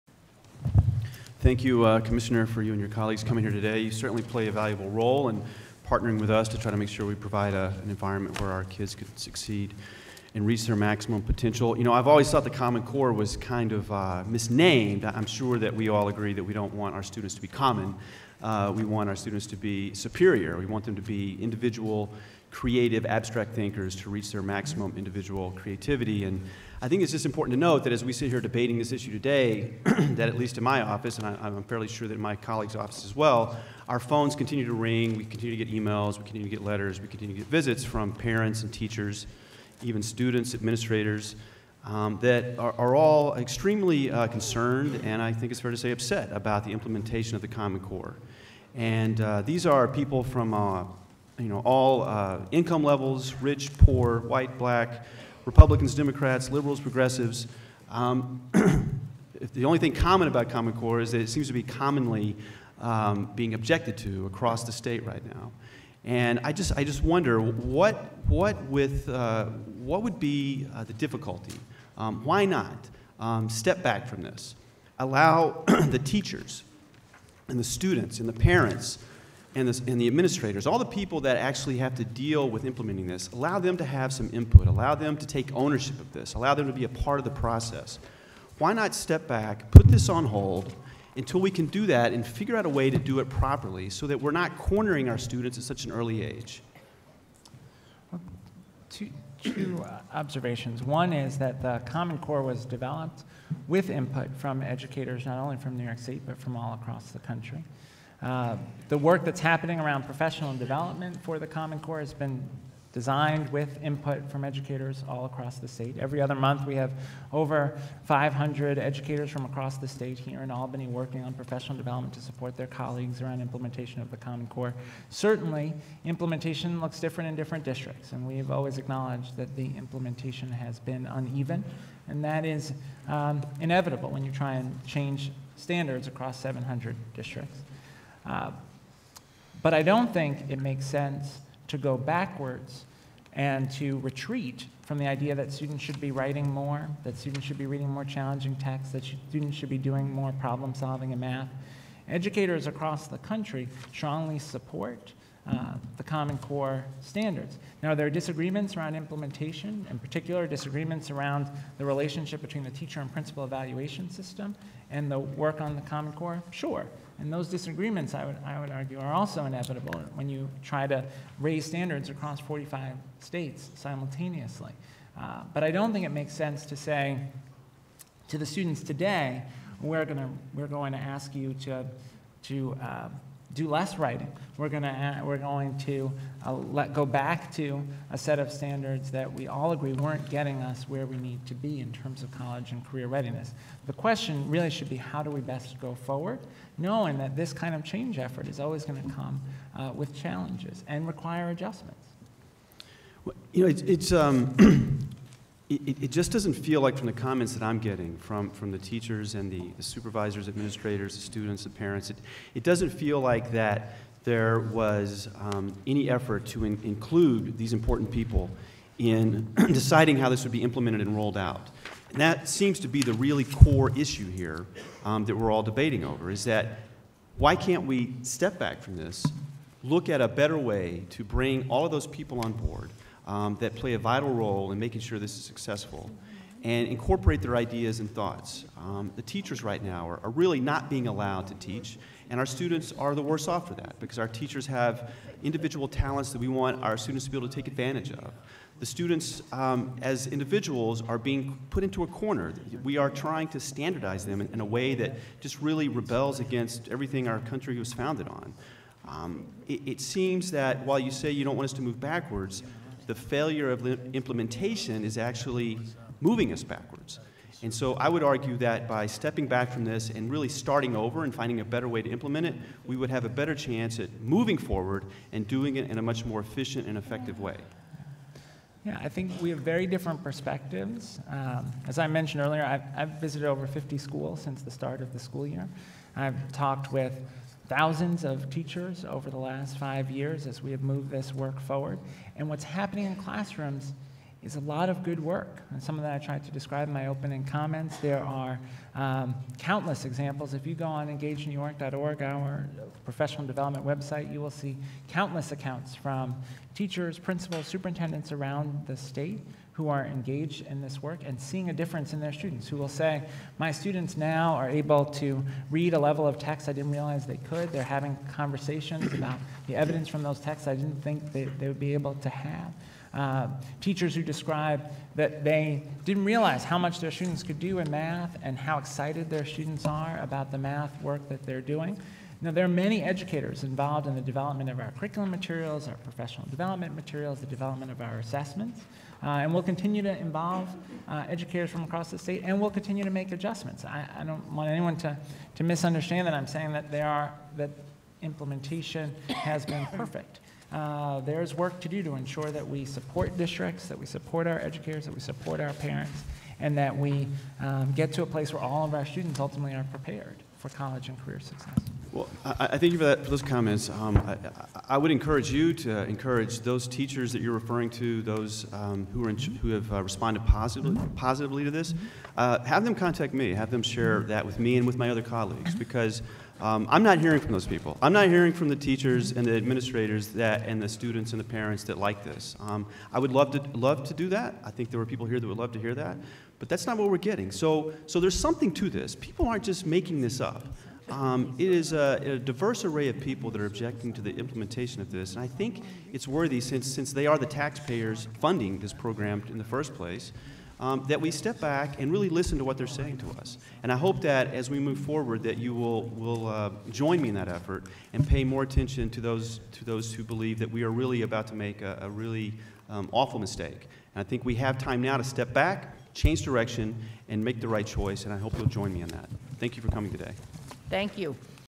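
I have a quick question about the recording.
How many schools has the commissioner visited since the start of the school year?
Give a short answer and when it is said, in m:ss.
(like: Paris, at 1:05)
over 50, at 4:43.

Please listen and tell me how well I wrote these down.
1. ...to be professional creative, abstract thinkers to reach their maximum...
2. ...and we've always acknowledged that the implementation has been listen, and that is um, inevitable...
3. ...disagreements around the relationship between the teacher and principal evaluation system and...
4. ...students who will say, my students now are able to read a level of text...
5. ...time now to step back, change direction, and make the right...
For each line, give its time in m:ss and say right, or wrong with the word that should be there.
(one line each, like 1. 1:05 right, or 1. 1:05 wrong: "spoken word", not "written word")
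1. 0:20 wrong: "individual", not "professional"
2. 2:08 wrong: "uneven", not "listen"
3. 2:40 right
4. 5:12 right
5. 6:54 right.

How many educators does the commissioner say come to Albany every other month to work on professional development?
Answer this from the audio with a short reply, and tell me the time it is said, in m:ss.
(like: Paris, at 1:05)
over 500, at 1:57.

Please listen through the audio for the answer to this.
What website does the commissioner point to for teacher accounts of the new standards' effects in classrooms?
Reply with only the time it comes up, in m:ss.
5:01.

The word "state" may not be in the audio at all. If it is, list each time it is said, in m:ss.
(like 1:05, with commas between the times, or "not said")
1:04, 1:45, 1:55, 1:59, 2:53, 5:08, 5:42.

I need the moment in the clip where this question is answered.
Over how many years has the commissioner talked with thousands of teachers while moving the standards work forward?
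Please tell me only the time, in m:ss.
4:49.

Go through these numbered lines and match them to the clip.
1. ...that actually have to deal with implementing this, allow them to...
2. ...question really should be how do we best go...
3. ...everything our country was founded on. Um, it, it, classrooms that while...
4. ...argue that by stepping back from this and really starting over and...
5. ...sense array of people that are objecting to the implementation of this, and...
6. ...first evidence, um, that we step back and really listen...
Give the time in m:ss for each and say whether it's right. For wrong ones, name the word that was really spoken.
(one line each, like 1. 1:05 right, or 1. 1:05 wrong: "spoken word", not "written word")
1. 1:21 right
2. 3:13 right
3. 4:16 wrong: "seems", not "classrooms"
4. 4:28 right
5. 6:32 wrong: "diverse", not "sense"
6. 6:39 wrong: "place", not "evidence".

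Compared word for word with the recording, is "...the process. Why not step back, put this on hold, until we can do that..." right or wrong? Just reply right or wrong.
right.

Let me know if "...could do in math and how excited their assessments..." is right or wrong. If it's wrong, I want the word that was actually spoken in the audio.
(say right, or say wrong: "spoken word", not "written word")
wrong: "students", not "assessments".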